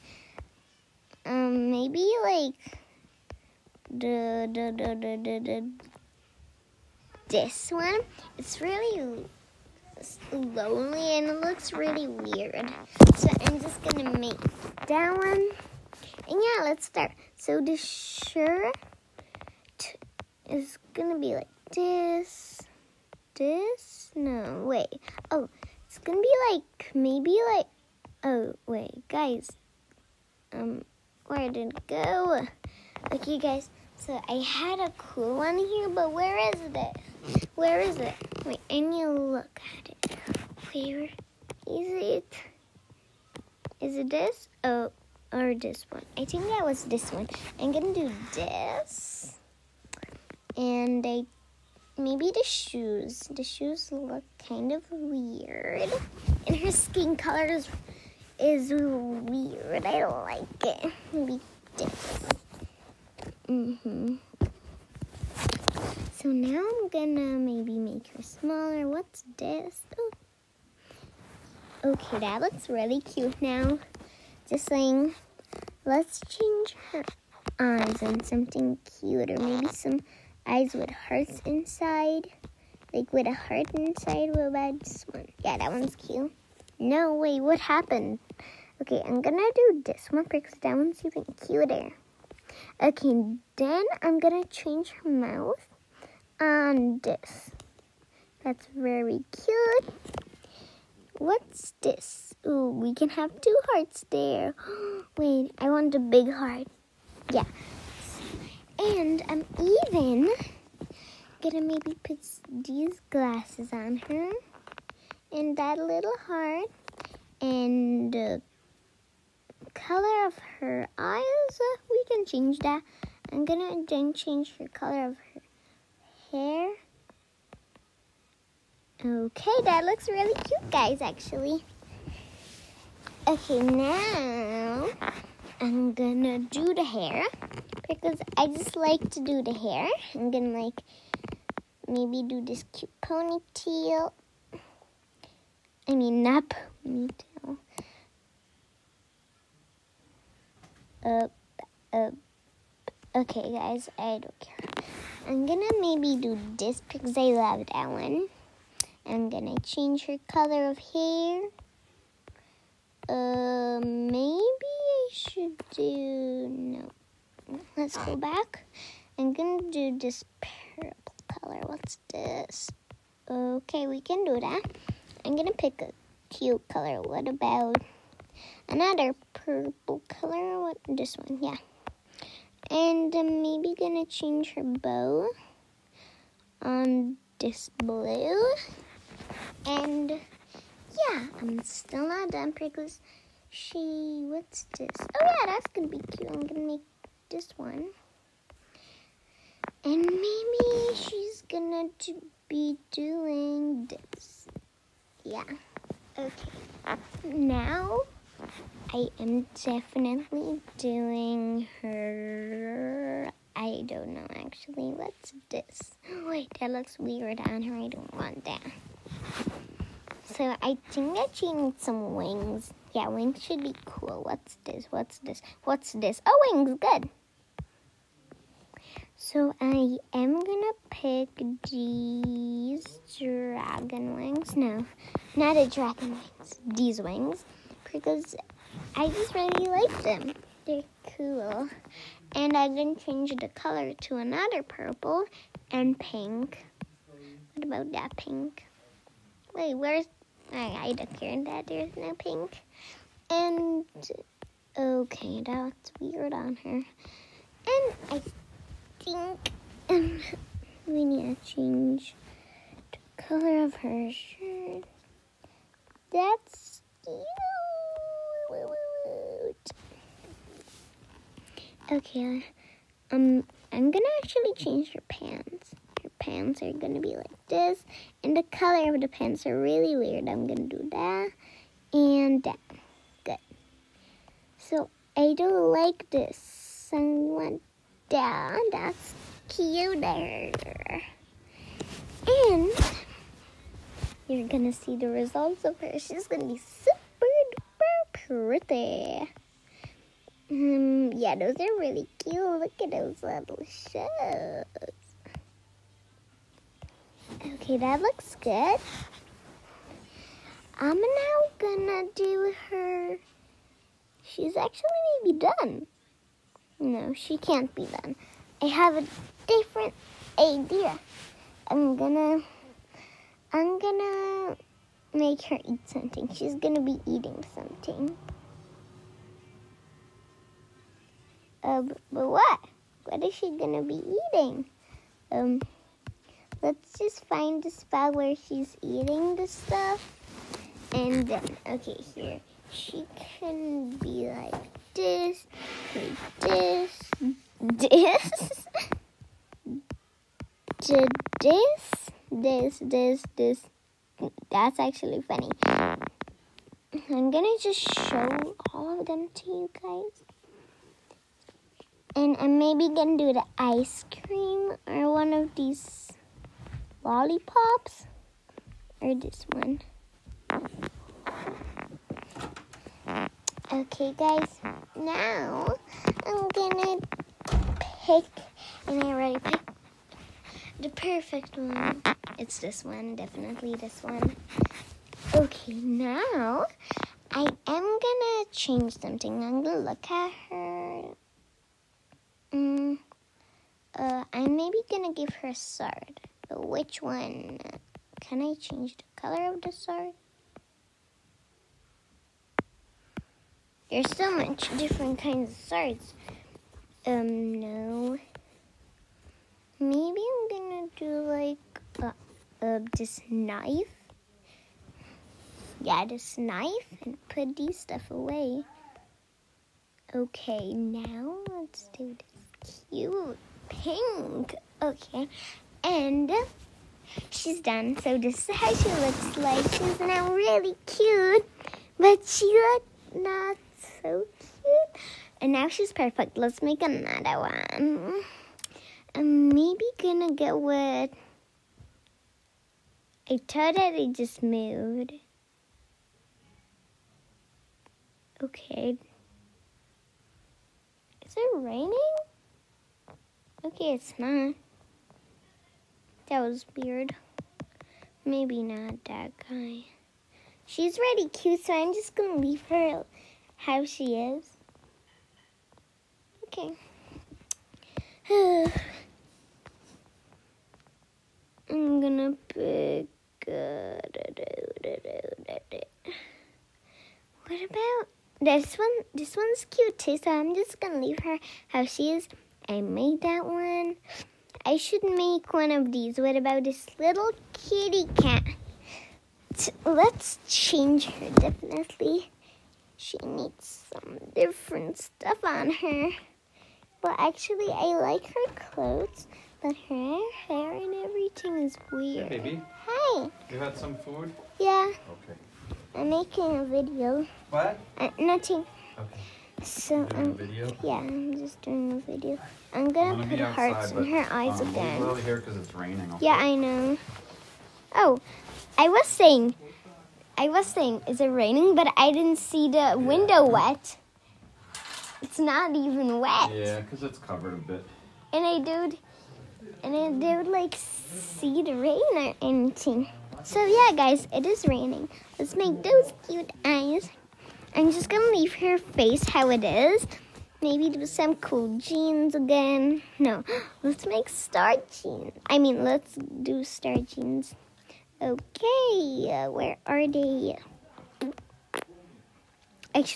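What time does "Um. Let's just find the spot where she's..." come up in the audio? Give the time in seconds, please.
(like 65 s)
335 s.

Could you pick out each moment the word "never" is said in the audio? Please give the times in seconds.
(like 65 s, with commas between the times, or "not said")
not said.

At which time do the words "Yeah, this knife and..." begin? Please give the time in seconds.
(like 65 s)
415 s.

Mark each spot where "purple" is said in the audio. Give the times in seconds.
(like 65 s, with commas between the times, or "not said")
170 s, 179 s, 244 s.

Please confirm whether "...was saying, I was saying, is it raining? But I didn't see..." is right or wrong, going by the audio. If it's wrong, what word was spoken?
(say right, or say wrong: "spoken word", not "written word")
right.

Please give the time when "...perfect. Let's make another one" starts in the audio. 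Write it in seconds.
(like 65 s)
435 s.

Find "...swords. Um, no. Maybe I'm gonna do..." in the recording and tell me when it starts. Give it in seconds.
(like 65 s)
405 s.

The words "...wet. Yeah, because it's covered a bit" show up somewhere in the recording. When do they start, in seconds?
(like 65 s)
526 s.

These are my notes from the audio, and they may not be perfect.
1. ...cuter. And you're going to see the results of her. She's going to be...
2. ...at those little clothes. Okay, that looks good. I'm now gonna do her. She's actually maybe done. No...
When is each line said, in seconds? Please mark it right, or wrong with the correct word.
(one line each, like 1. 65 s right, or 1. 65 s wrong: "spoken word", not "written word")
1. 289 s right
2. 302 s wrong: "shoes", not "clothes".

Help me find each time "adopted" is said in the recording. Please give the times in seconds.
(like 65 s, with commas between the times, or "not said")
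not said.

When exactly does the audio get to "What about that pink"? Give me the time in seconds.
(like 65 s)
247 s.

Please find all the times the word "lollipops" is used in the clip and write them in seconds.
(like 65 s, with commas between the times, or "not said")
367 s.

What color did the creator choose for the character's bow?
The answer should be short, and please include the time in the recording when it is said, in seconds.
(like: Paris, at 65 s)
blue, at 187 s.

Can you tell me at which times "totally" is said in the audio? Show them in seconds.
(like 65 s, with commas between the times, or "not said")
443 s.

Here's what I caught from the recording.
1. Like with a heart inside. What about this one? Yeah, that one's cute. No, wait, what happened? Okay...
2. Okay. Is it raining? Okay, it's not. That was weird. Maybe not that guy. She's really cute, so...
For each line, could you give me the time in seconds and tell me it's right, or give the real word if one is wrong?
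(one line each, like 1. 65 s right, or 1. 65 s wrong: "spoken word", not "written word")
1. 82 s right
2. 448 s right.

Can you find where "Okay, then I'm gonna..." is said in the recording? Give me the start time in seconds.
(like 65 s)
92 s.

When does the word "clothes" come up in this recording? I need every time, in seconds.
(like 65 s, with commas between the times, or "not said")
498 s.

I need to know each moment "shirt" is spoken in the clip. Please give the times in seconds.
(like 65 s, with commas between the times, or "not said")
17 s, 264 s.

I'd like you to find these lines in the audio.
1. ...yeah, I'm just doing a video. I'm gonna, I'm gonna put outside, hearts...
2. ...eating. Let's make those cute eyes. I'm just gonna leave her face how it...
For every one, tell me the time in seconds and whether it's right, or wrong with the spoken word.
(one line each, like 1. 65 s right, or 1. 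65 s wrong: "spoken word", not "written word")
1. 510 s right
2. 534 s wrong: "raining", not "eating".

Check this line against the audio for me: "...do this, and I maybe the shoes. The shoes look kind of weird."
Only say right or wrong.
right.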